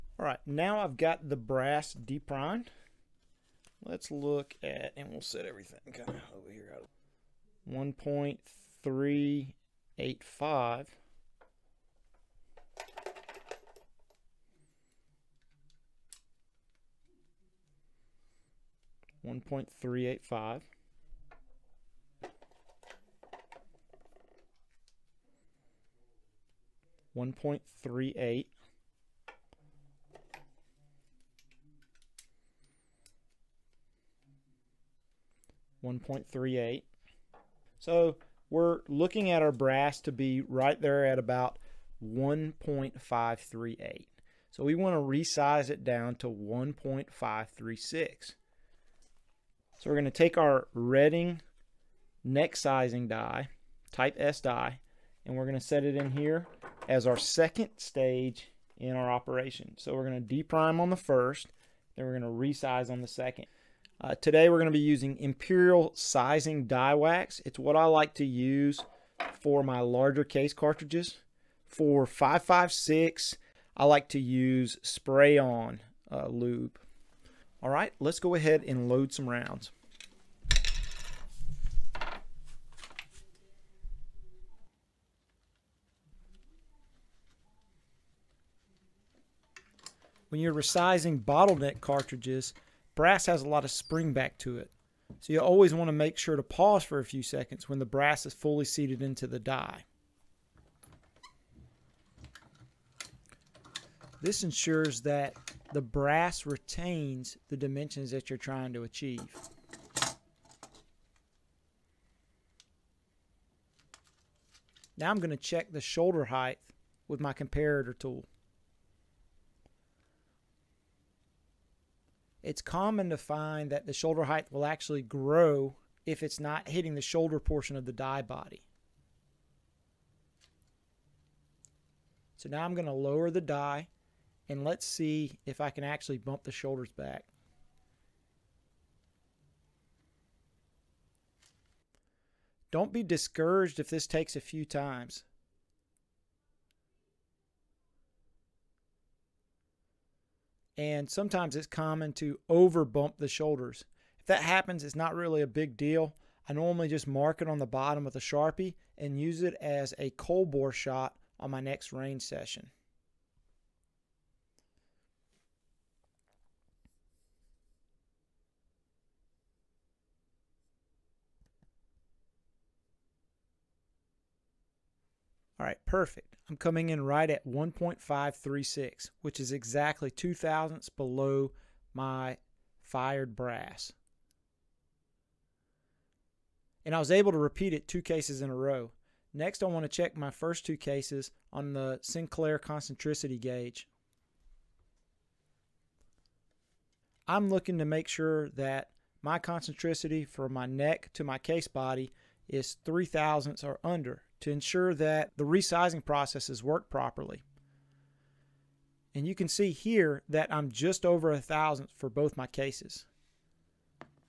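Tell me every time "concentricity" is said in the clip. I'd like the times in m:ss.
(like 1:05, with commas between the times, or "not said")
3:12, 3:19.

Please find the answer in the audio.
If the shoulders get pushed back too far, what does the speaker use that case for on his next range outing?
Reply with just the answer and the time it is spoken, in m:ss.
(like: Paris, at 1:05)
cold bore shot, at 2:40.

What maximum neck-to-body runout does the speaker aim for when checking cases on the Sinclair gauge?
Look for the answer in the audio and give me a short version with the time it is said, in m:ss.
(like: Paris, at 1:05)
3 thousandths, at 3:22.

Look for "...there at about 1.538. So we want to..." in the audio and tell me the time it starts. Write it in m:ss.
0:40.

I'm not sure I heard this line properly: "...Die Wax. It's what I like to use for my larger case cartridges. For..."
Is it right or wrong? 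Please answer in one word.
right.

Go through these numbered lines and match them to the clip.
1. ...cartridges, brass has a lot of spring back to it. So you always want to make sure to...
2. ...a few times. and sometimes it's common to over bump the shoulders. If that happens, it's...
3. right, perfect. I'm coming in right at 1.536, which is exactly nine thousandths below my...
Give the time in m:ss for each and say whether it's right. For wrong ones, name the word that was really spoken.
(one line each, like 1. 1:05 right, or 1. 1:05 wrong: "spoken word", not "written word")
1. 1:31 right
2. 2:24 right
3. 2:55 wrong: "two", not "nine".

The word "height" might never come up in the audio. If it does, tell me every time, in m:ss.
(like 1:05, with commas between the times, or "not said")
1:56, 2:04.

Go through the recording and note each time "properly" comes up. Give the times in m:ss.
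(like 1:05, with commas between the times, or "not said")
3:26.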